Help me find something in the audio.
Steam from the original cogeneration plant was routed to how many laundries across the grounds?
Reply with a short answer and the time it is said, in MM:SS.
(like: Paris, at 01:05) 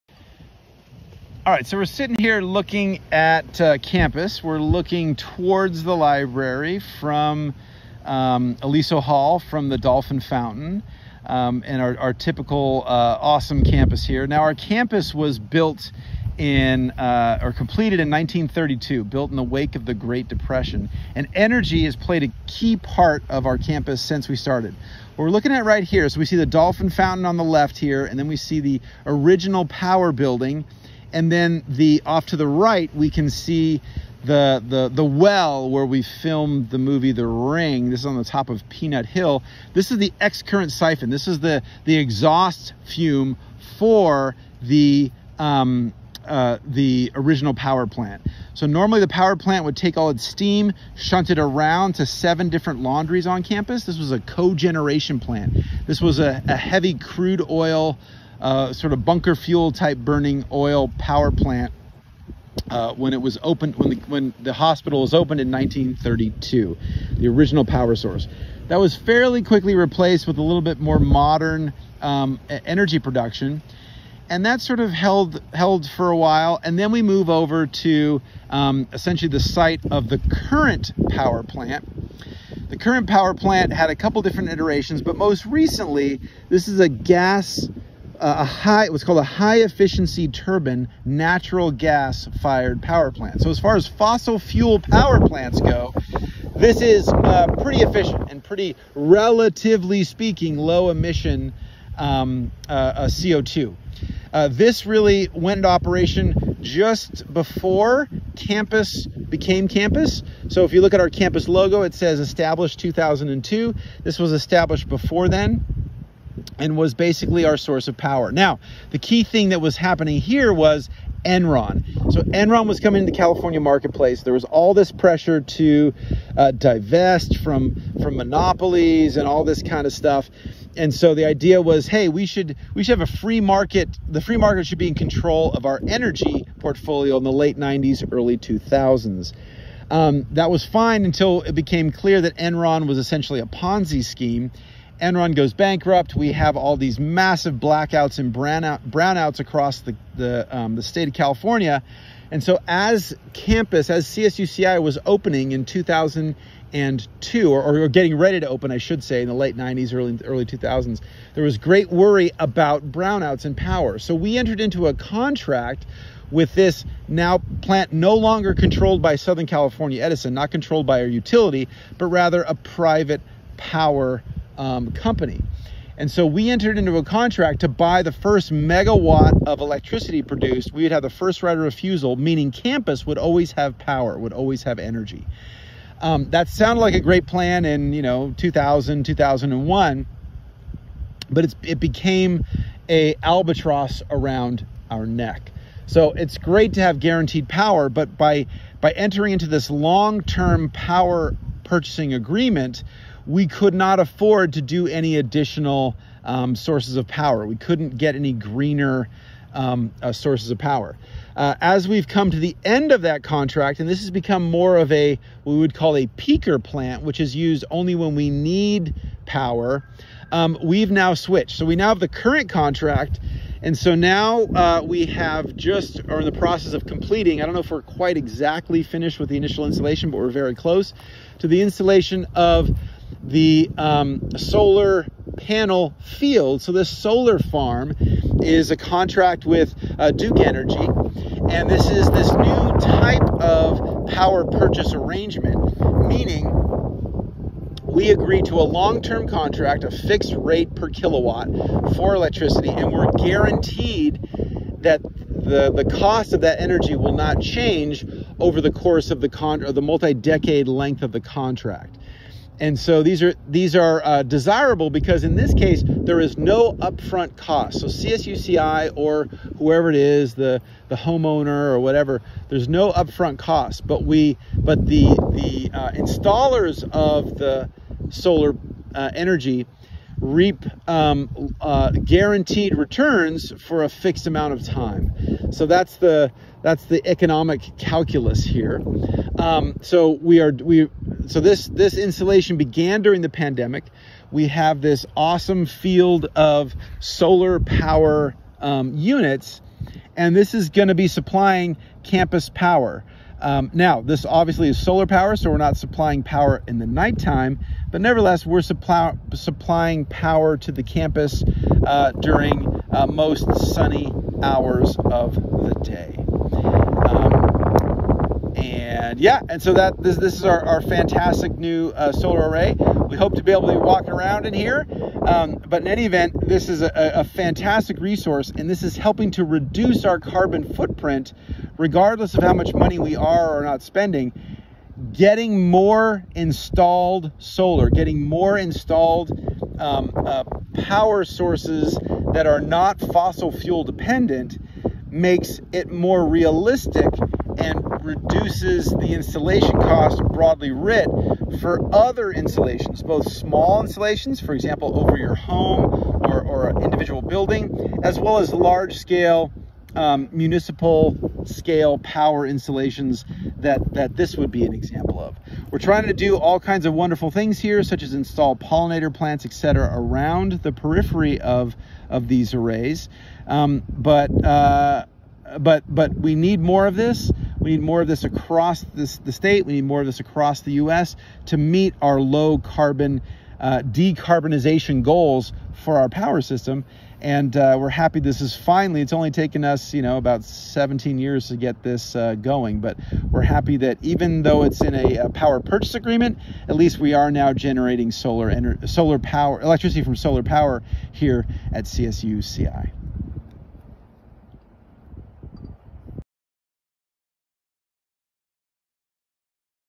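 7, at 00:52.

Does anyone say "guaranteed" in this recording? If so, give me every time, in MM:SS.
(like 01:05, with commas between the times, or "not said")
03:16, 04:13, 04:41.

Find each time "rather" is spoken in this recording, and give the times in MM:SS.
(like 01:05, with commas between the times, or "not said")
02:52.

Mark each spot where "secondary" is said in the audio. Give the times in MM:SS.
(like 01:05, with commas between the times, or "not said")
not said.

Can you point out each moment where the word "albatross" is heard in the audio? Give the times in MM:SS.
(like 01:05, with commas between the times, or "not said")
03:13.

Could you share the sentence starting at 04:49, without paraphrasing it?
Um, so we are we so this this installation began during the pandemic.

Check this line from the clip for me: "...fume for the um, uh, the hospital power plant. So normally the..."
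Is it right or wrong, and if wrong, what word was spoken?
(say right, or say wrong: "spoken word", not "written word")
wrong: "original", not "hospital".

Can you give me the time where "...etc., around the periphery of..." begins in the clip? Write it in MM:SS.
06:09.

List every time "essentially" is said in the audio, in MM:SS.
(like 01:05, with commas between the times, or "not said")
01:18, 02:22.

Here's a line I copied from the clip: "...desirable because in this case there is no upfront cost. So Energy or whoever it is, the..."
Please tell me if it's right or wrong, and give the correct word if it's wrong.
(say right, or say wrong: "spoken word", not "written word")
wrong: "CSUCI", not "Energy".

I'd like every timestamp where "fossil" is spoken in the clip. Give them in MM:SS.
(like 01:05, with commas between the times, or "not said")
01:33, 05:42.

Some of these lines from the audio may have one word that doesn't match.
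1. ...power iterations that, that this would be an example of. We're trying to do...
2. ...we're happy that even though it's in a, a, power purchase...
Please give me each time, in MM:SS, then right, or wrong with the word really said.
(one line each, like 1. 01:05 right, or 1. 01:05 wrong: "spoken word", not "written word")
1. 06:01 wrong: "installations", not "iterations"
2. 06:33 right.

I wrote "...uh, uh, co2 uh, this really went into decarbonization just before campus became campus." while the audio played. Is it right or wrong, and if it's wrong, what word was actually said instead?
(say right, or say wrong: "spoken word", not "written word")
wrong: "operation", not "decarbonization".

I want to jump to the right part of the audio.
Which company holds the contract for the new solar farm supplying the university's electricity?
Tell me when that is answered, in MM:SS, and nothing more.
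04:00.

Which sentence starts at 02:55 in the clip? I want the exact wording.
And so we entered into a contract to buy the first megawatt of electricity produced.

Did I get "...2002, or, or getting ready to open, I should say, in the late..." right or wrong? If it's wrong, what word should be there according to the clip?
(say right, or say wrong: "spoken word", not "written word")
right.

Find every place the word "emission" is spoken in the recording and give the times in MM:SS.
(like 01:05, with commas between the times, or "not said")
01:40.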